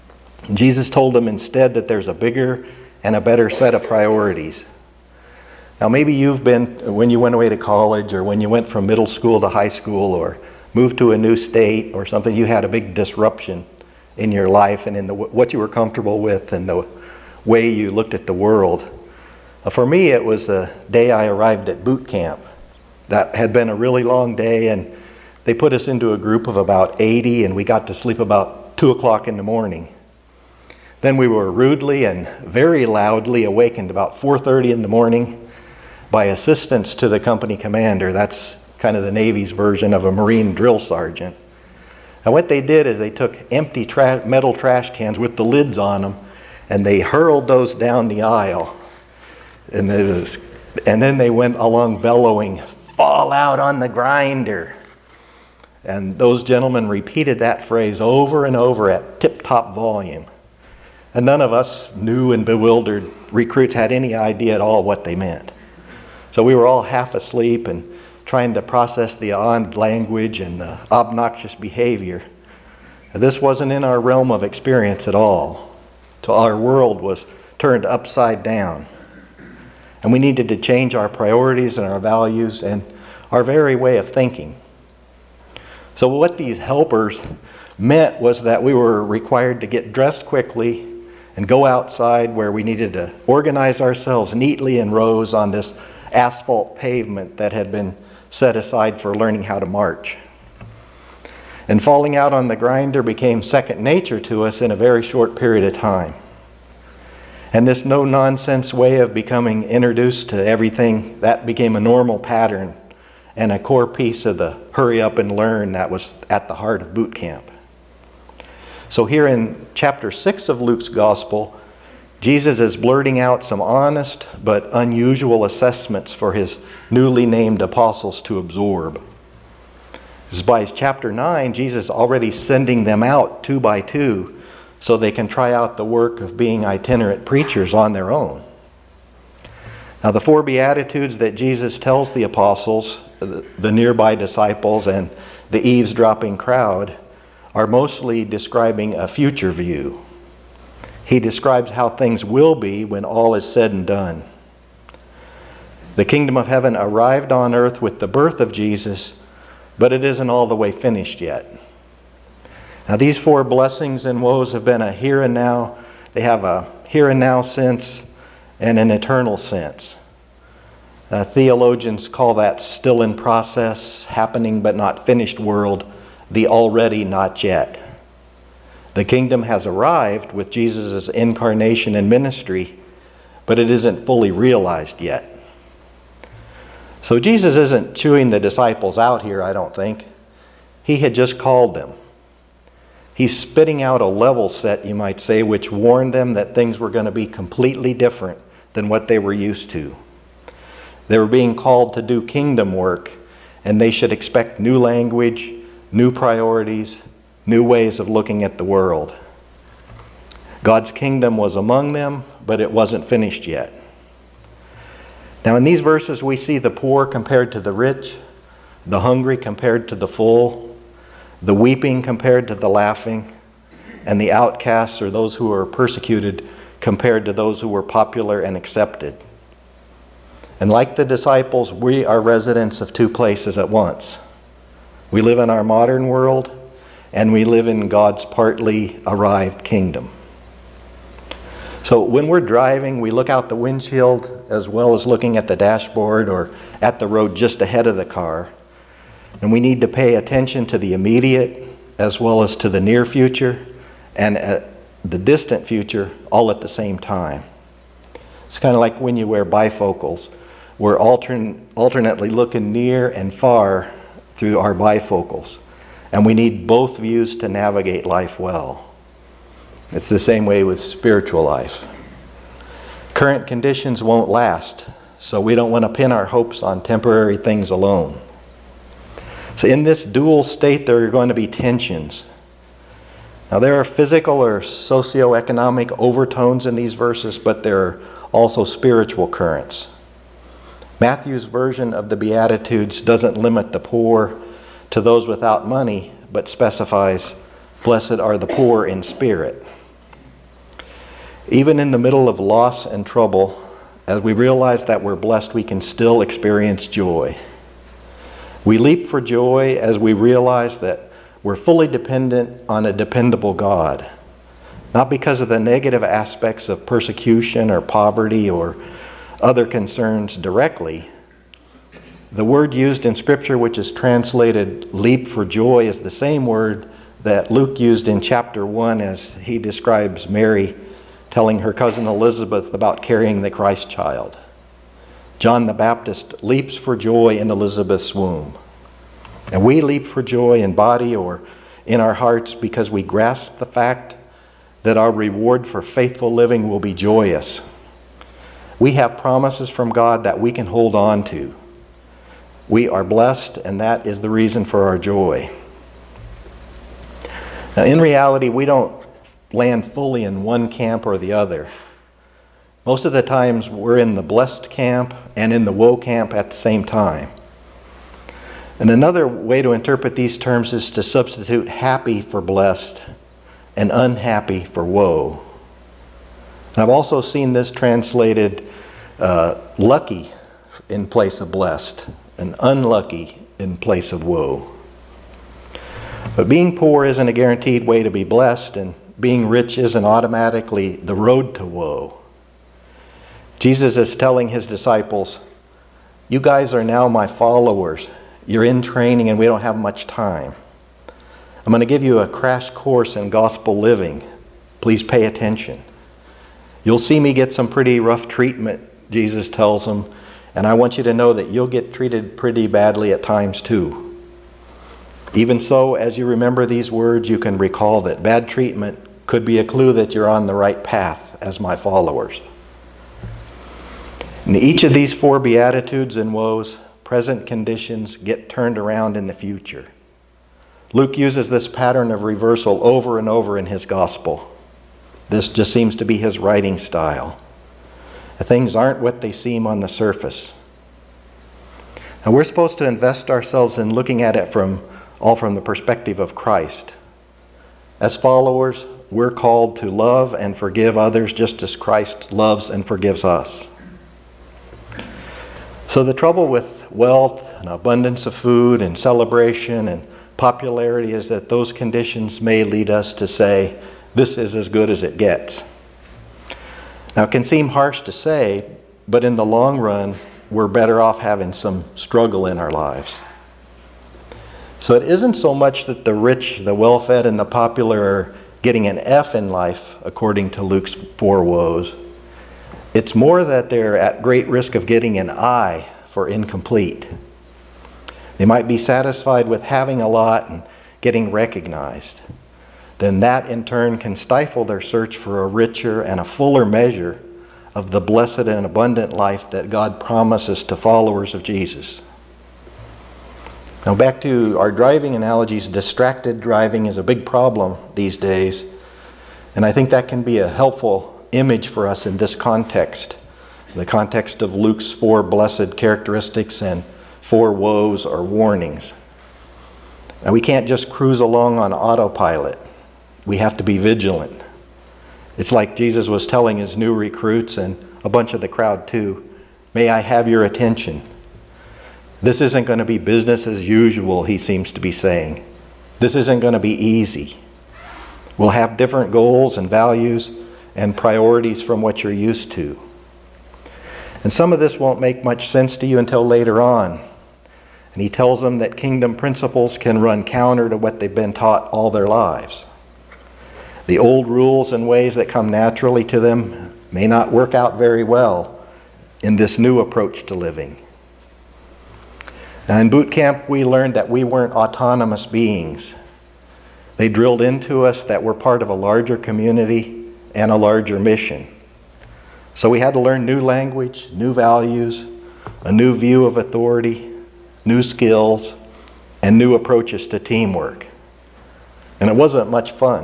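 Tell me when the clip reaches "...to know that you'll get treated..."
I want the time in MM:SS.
06:51.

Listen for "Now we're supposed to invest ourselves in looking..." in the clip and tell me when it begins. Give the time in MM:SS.
07:22.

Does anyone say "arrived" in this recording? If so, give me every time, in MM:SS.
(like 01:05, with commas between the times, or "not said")
00:21, 02:36, 02:59, 03:59.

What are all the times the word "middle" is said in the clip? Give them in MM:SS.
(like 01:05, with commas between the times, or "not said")
00:08, 05:01.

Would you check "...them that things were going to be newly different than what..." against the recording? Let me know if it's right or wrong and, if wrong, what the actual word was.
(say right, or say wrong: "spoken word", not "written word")
wrong: "completely", not "newly".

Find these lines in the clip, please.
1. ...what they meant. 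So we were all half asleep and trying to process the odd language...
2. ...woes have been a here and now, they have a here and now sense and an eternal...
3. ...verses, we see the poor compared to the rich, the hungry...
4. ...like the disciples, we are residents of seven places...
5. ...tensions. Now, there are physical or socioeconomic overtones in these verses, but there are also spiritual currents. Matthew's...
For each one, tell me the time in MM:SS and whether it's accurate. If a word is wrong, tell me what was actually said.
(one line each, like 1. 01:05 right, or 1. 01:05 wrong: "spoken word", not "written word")
1. 01:04 right
2. 02:44 right
3. 03:35 right
4. 03:50 wrong: "two", not "seven"
5. 04:41 right.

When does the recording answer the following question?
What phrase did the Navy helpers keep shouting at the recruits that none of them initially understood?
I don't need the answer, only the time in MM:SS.
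00:52.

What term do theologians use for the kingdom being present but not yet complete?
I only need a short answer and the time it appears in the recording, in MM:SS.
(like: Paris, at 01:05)
The already not yet, at 02:56.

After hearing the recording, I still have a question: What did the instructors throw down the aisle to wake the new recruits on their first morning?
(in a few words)
metal trash cans.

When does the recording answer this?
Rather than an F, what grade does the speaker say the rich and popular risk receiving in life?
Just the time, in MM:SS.
08:05.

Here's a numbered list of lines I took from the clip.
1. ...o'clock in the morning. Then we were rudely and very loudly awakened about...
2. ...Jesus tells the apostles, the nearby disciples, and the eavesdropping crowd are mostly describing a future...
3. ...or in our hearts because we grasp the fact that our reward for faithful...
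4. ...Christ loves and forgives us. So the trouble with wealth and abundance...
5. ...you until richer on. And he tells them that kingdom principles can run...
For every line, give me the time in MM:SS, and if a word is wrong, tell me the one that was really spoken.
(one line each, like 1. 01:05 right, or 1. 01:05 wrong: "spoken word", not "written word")
1. 00:28 right
2. 02:21 right
3. 05:41 right
4. 07:31 right
5. 09:05 wrong: "later", not "richer".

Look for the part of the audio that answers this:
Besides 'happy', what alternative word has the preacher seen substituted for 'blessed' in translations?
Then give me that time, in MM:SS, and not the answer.
06:19.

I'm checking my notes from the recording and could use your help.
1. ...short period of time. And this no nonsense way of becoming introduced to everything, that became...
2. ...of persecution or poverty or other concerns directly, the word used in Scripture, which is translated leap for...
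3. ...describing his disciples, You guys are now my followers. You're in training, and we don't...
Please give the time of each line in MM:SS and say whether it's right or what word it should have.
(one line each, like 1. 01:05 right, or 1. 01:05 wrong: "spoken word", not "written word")
1. 01:45 right
2. 05:16 right
3. 06:34 wrong: "telling", not "describing".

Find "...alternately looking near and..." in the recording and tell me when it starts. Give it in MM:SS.
04:21.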